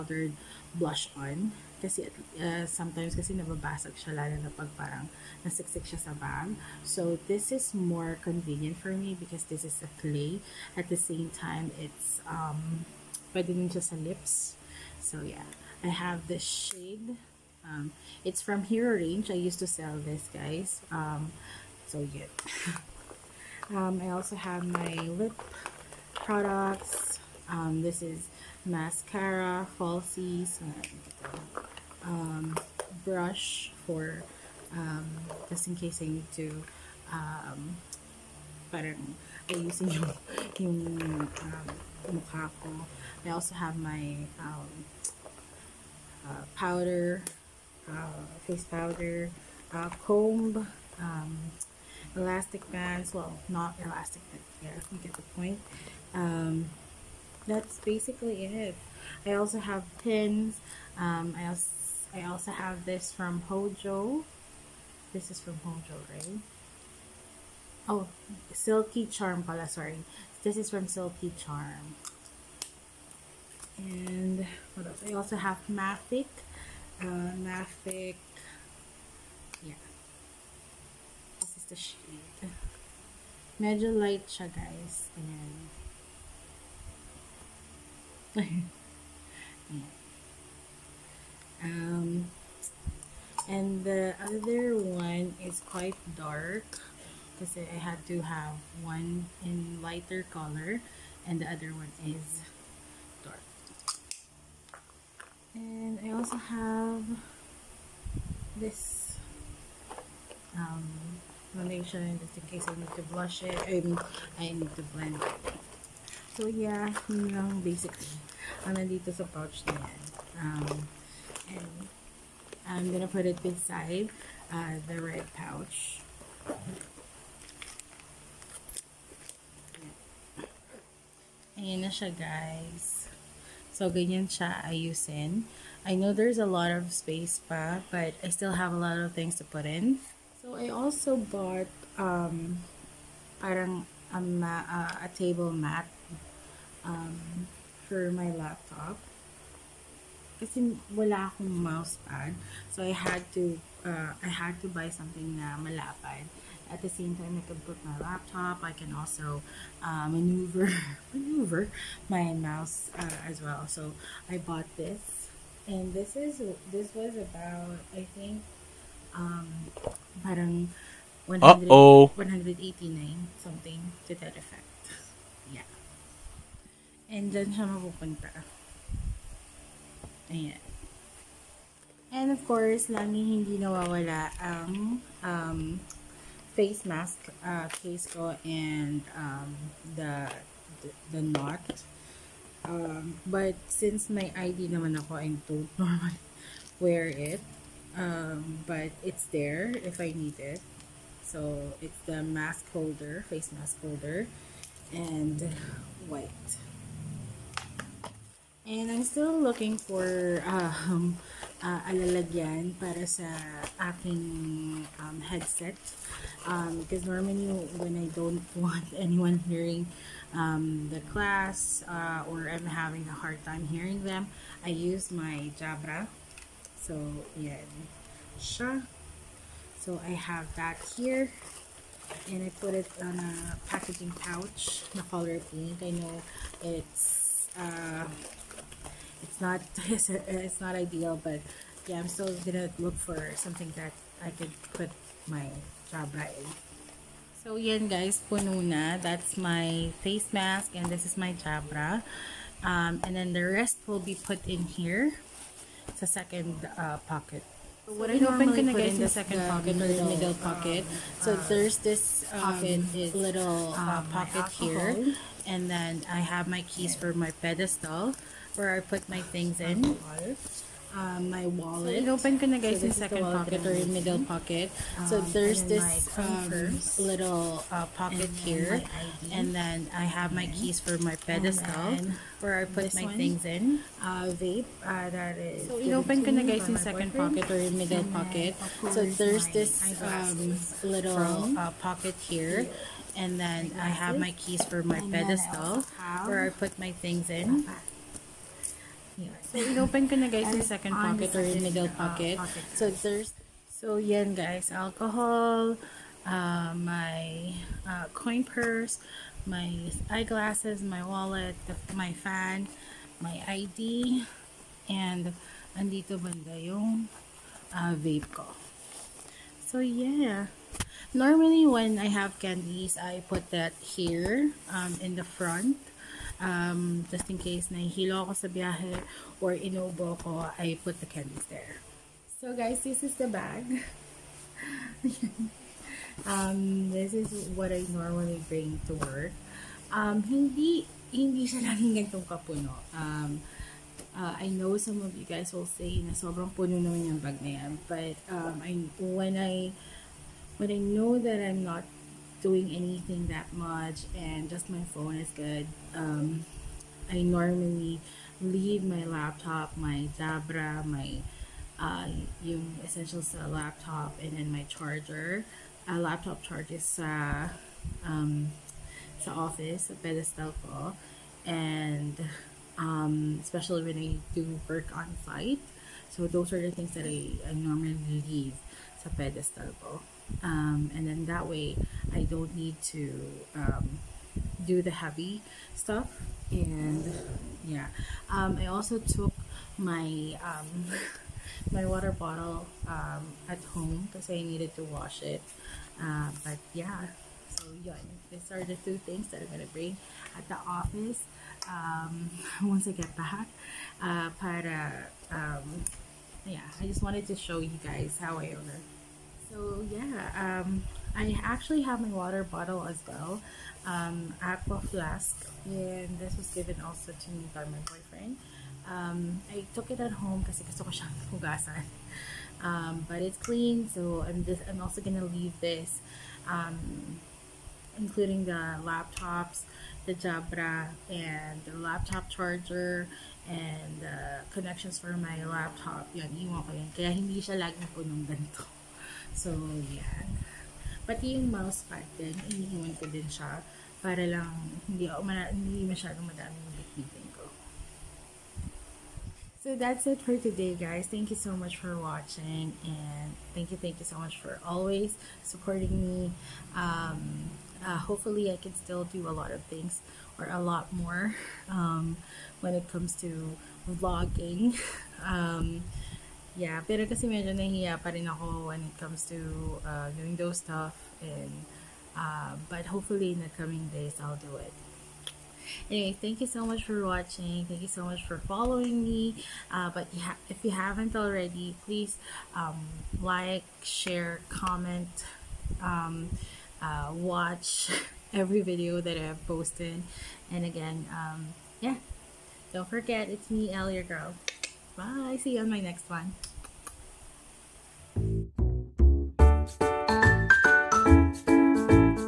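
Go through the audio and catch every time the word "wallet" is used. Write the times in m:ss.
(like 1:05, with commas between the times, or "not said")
4:31, 5:11.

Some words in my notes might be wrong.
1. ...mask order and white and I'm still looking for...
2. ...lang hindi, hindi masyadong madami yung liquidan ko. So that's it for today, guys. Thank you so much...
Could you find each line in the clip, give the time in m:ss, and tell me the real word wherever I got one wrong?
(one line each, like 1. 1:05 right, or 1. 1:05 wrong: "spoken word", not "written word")
1. 3:23 wrong: "holder", not "order"
2. 7:24 right.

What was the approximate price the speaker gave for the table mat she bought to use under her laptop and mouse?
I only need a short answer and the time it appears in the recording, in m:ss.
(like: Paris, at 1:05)
189, at 2:52.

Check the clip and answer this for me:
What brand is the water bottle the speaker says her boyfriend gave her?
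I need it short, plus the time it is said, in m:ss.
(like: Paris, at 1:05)
Aqua Flask, at 6:54.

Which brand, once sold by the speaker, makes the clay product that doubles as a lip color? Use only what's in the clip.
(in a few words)
Hero Range.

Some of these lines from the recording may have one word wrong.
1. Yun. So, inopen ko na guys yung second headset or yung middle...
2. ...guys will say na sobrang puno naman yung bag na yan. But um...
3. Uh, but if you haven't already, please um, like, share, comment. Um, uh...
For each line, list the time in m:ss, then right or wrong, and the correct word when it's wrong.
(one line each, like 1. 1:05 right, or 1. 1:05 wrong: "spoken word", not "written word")
1. 4:59 wrong: "pocket", not "headset"
2. 5:45 right
3. 7:59 right.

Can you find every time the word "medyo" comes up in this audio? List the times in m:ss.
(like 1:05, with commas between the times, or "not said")
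1:23, 7:47.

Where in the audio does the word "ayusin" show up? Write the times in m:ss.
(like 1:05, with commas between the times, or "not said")
0:39, 2:14.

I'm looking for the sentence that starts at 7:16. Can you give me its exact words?
Kaya hindi siya laging punong ganito.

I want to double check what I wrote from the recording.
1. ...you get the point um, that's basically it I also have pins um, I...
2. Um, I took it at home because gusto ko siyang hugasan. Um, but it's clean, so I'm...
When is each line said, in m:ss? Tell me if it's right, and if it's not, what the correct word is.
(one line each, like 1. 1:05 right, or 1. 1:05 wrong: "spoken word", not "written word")
1. 0:54 right
2. 6:58 right.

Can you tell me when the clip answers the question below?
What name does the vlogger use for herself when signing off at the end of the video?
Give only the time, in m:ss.
8:13.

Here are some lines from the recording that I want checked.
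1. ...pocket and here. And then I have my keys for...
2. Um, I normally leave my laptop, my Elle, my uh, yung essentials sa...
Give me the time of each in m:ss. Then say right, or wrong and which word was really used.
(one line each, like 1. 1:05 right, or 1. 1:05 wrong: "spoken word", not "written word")
1. 4:37 right
2. 5:55 wrong: "Jabra", not "Elle".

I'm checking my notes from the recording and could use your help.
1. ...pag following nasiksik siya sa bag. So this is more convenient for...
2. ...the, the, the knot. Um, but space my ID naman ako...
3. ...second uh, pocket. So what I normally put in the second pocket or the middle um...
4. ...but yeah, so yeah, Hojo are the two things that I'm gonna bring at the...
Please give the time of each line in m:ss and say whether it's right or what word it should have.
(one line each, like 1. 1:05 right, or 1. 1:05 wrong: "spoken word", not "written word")
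1. 0:04 wrong: "parang", not "following"
2. 3:09 wrong: "since", not "space"
3. 4:16 right
4. 6:36 wrong: "These", not "Hojo".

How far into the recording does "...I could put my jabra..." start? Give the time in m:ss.
4:04.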